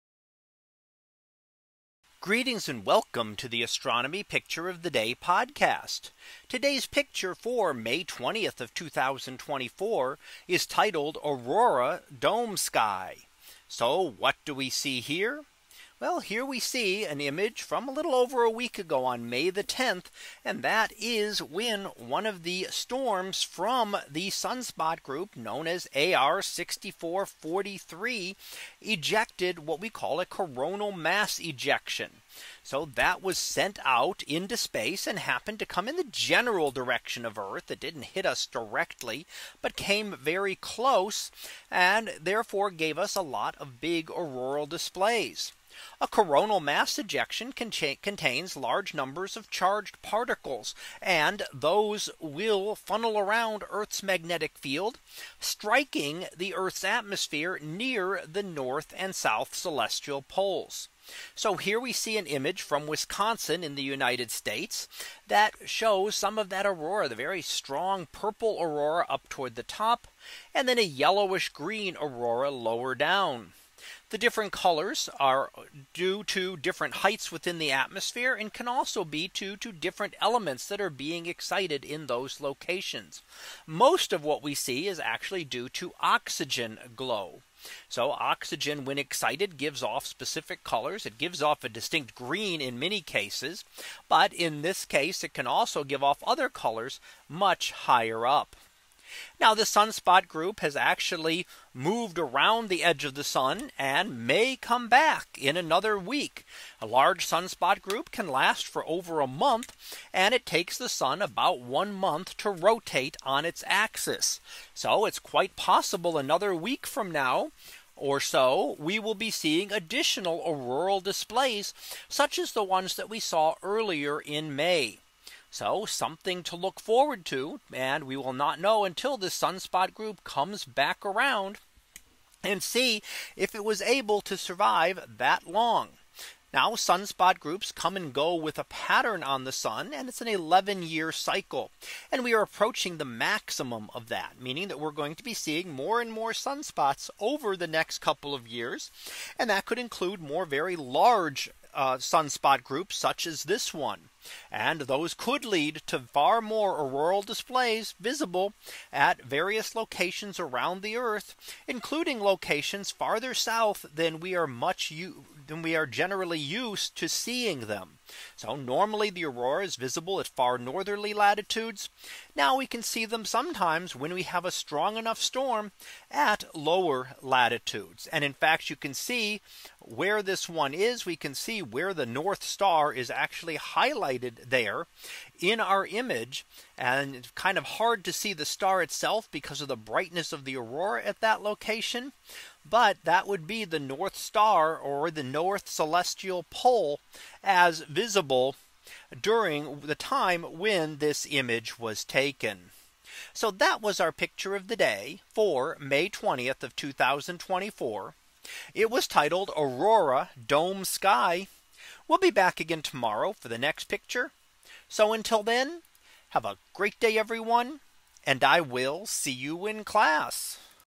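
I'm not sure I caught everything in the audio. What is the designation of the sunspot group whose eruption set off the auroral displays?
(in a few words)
AR 6443.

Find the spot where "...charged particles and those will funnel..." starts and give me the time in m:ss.
0:49.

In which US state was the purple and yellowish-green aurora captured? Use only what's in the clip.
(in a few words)
Wisconsin.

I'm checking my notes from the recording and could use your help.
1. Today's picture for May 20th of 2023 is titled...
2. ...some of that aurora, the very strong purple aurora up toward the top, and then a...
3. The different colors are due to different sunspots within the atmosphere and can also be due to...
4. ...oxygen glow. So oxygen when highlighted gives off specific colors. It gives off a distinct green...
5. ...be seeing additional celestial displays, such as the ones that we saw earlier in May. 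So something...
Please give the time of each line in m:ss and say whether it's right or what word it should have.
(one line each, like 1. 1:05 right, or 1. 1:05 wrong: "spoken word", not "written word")
1. 0:06 wrong: "2024", not "2023"
2. 1:06 right
3. 1:14 wrong: "heights", not "sunspots"
4. 1:25 wrong: "excited", not "highlighted"
5. 1:59 wrong: "auroral", not "celestial".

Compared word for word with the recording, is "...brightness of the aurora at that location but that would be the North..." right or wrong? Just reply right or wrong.
right.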